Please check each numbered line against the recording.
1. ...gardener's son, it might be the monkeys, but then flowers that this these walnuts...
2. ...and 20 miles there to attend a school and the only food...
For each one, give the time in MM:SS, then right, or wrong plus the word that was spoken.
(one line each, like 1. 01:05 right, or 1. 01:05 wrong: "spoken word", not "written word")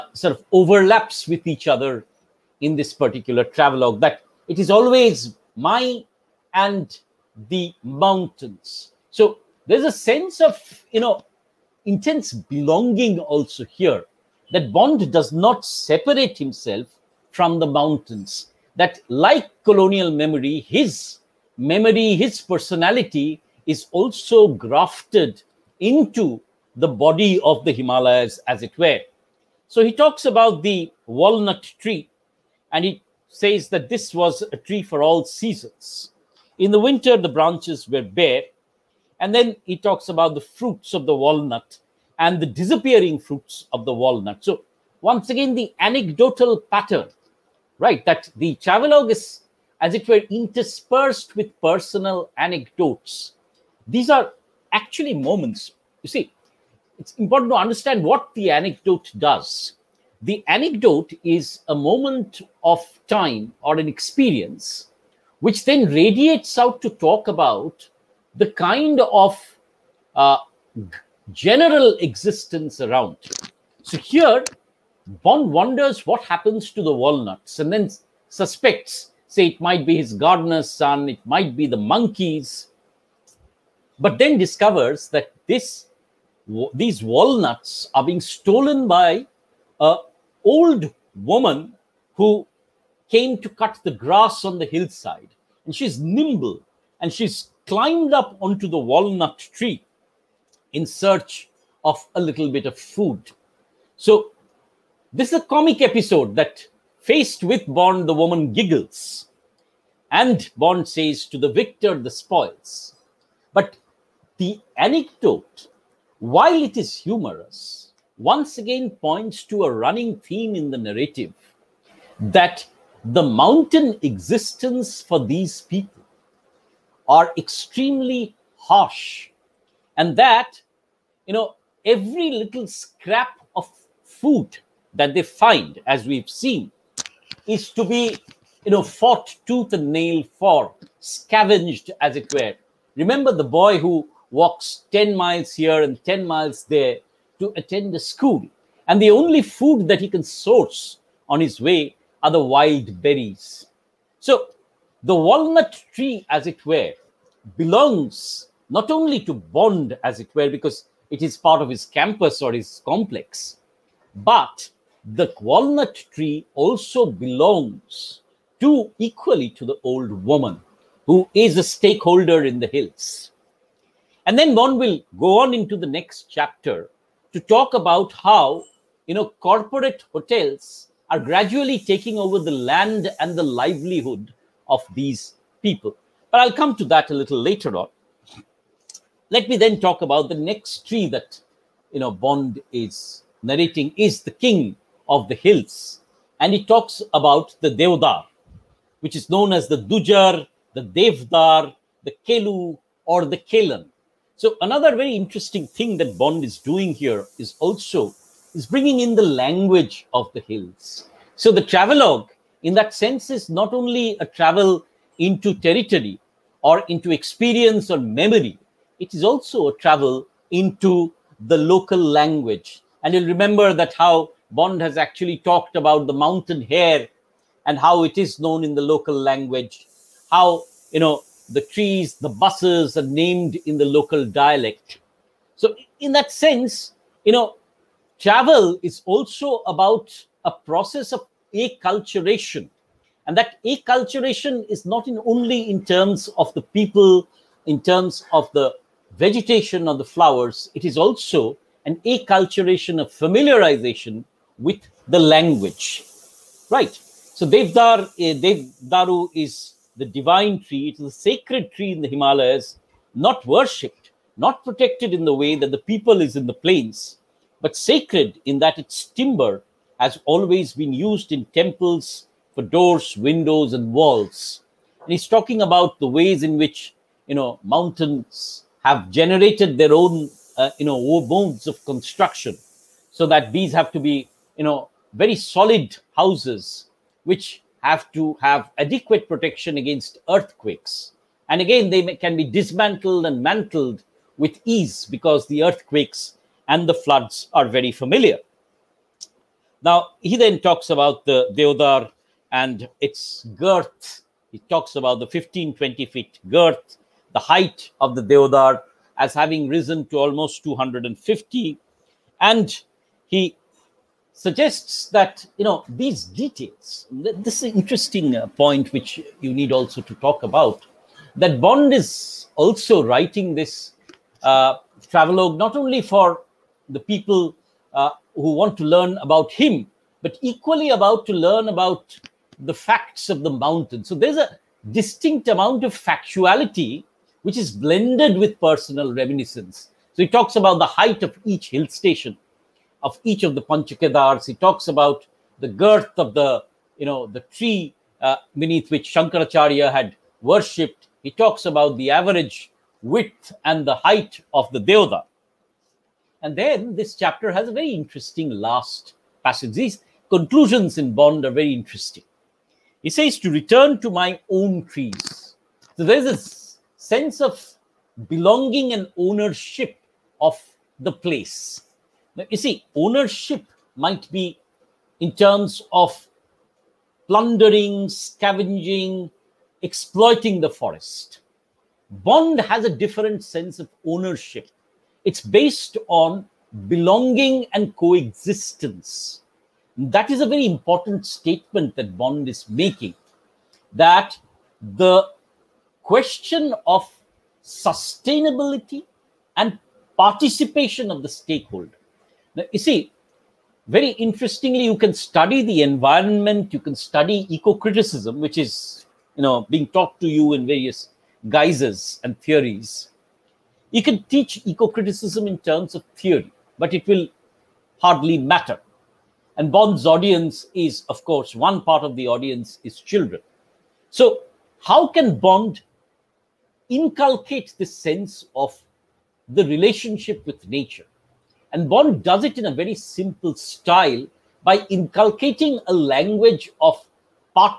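1. 01:20 wrong: "discovers", not "flowers"
2. 02:25 wrong: "10", not "20".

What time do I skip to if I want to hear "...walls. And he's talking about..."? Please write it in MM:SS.
04:33.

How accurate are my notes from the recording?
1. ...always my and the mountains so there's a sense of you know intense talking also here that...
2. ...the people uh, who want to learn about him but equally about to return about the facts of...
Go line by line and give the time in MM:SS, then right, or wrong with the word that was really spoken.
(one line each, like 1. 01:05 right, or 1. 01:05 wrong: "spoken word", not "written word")
1. 00:04 wrong: "belonging", not "talking"
2. 05:26 wrong: "learn", not "return".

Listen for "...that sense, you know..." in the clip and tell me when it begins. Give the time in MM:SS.
03:56.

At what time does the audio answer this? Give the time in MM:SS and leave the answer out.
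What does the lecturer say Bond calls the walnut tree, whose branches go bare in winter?
00:34.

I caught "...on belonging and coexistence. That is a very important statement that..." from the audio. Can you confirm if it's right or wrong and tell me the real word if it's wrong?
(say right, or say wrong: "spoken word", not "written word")
right.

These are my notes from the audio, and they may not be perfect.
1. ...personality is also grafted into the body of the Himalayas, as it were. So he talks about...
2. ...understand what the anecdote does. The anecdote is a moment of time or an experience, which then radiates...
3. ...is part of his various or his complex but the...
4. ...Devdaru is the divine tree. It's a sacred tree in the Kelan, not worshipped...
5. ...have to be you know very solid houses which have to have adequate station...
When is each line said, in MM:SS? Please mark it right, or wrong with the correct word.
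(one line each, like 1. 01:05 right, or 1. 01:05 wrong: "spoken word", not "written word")
1. 00:22 right
2. 00:57 right
3. 02:41 wrong: "campus", not "various"
4. 04:18 wrong: "Himalayas", not "Kelan"
5. 04:43 wrong: "protection", not "station".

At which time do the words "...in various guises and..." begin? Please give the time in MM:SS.
06:50.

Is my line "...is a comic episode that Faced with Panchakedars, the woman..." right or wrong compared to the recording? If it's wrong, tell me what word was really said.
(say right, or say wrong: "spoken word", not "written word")
wrong: "Bond", not "Panchakedars".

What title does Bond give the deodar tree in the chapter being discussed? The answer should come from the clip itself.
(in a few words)
King of the hills.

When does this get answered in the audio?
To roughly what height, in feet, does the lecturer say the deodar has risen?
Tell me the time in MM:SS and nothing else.
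05:10.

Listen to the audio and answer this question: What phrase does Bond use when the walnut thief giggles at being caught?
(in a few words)
To the victor, the spoils.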